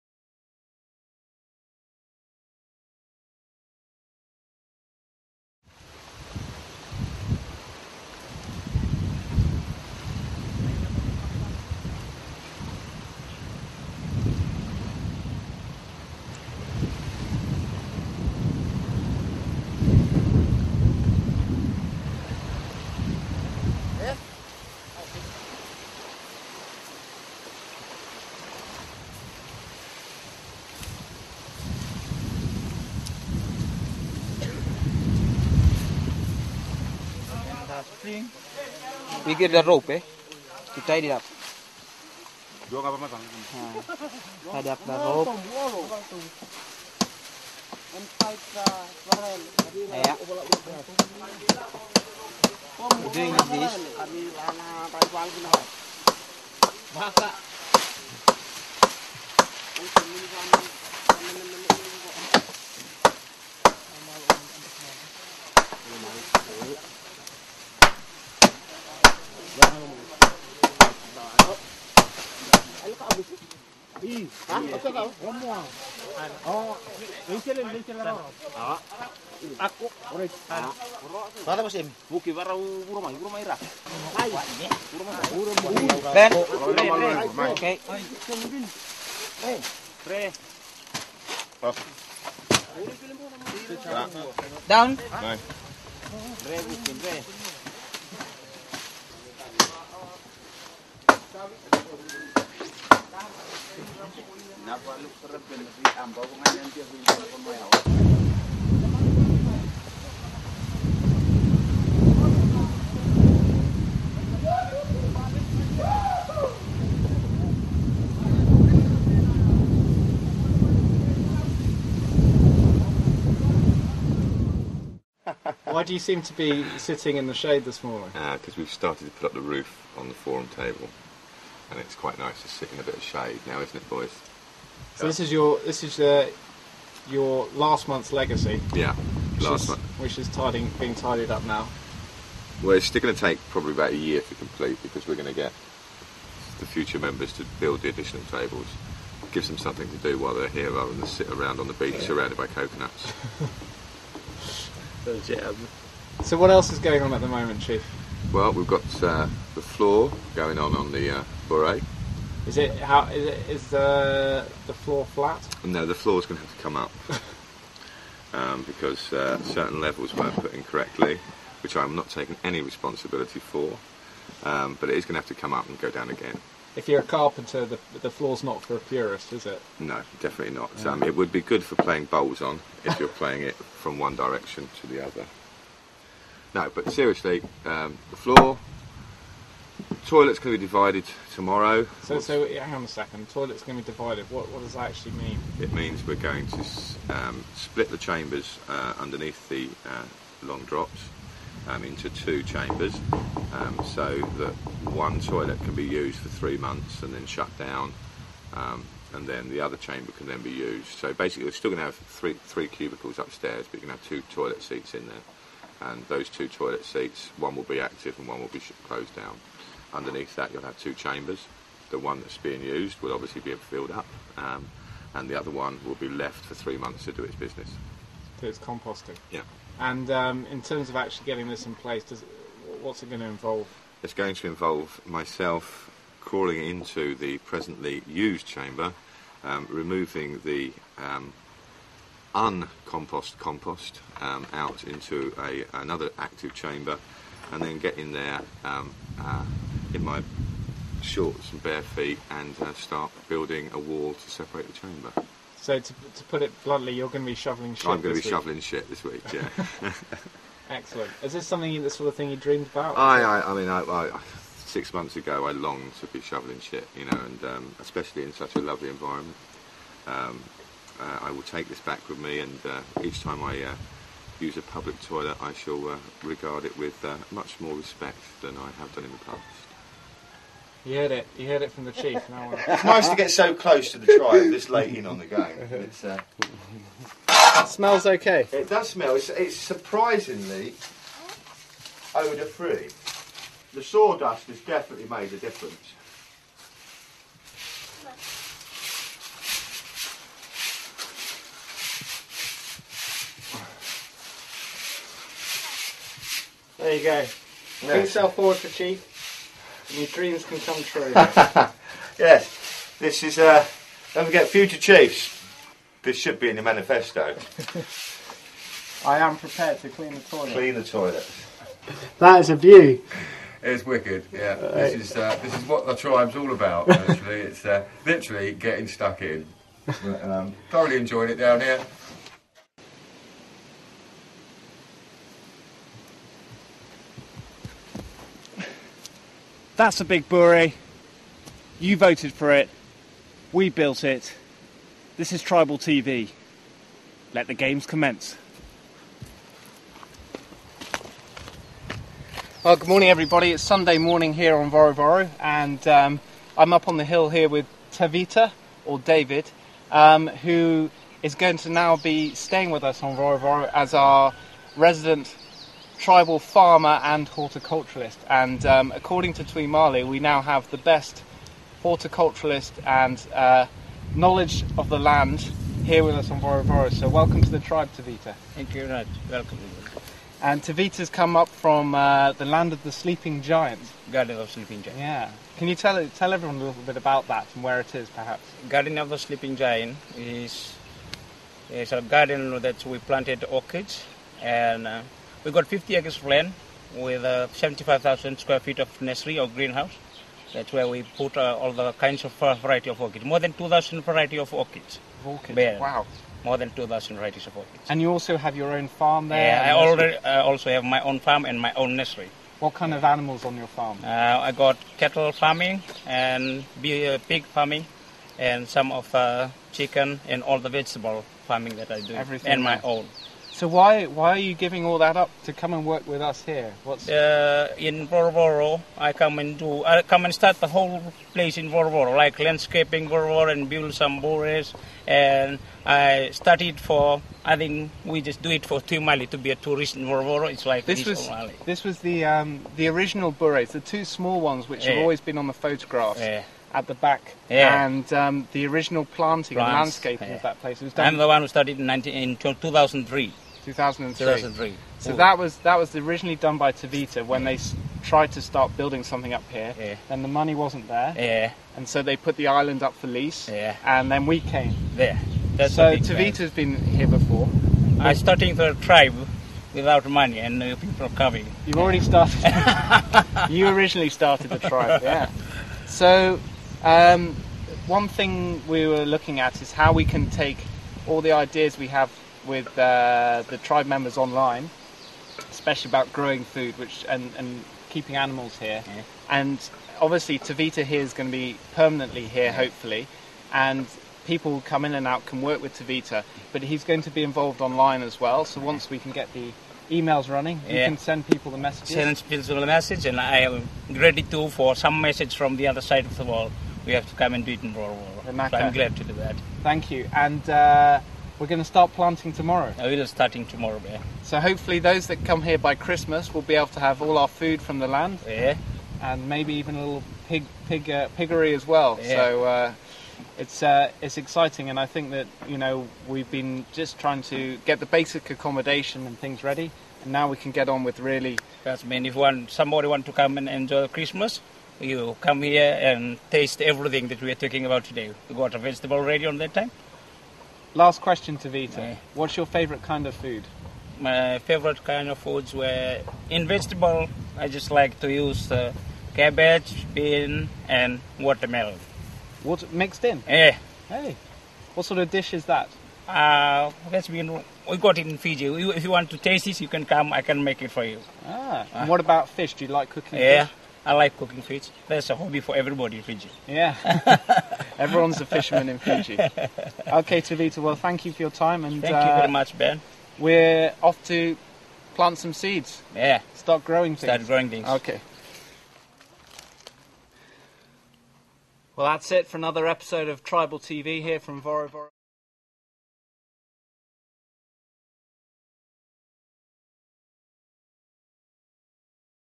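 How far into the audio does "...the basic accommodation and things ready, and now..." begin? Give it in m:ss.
8:47.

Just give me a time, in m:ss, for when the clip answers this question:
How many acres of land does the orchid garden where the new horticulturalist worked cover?
6:35.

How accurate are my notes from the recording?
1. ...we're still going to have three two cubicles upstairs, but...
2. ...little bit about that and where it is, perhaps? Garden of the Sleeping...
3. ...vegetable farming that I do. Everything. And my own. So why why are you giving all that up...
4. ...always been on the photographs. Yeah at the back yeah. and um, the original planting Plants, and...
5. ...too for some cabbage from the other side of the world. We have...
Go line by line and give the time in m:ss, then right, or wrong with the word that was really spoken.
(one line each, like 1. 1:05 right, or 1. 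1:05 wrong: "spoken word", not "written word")
1. 3:31 wrong: "three", not "two"
2. 6:26 right
3. 7:00 right
4. 7:25 right
5. 8:24 wrong: "message", not "cabbage".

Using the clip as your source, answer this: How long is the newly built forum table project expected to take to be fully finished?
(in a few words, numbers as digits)
about a year.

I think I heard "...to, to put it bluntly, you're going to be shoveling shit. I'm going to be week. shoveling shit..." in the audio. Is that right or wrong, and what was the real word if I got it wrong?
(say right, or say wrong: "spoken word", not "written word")
right.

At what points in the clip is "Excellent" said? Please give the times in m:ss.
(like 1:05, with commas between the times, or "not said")
4:20.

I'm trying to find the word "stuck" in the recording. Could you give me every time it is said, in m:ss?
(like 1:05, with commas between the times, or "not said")
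5:28.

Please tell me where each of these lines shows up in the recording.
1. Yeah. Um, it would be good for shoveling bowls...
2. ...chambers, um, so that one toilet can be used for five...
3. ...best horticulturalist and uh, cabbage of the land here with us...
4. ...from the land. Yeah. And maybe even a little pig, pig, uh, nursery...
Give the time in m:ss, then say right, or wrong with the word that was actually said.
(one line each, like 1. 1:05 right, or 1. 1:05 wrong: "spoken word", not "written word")
1. 3:00 wrong: "playing", not "shoveling"
2. 3:22 wrong: "three", not "five"
3. 6:10 wrong: "knowledge", not "cabbage"
4. 8:37 wrong: "piggery", not "nursery".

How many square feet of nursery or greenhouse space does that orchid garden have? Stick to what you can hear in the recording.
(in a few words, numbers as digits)
75,000.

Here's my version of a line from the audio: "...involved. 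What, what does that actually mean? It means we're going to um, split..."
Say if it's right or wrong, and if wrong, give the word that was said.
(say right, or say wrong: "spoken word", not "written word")
wrong: "divided", not "involved".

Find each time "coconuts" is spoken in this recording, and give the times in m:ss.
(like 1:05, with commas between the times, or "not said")
2:32.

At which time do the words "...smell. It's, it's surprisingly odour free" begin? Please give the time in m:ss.
4:48.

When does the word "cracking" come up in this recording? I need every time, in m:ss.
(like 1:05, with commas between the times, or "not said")
not said.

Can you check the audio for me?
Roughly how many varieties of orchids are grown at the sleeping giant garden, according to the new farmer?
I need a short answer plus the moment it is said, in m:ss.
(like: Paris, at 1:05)
more than 2,000, at 6:43.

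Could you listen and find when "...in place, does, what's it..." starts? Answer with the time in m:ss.
3:51.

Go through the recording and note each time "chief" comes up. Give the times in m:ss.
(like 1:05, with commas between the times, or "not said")
2:37, 4:41, 5:08, 5:14.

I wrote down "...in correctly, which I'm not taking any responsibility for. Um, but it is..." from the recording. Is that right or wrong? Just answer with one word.
right.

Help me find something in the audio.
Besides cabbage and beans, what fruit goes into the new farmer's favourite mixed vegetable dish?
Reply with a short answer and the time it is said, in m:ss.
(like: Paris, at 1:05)
watermelon, at 9:11.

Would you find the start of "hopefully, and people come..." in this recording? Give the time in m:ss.
8:12.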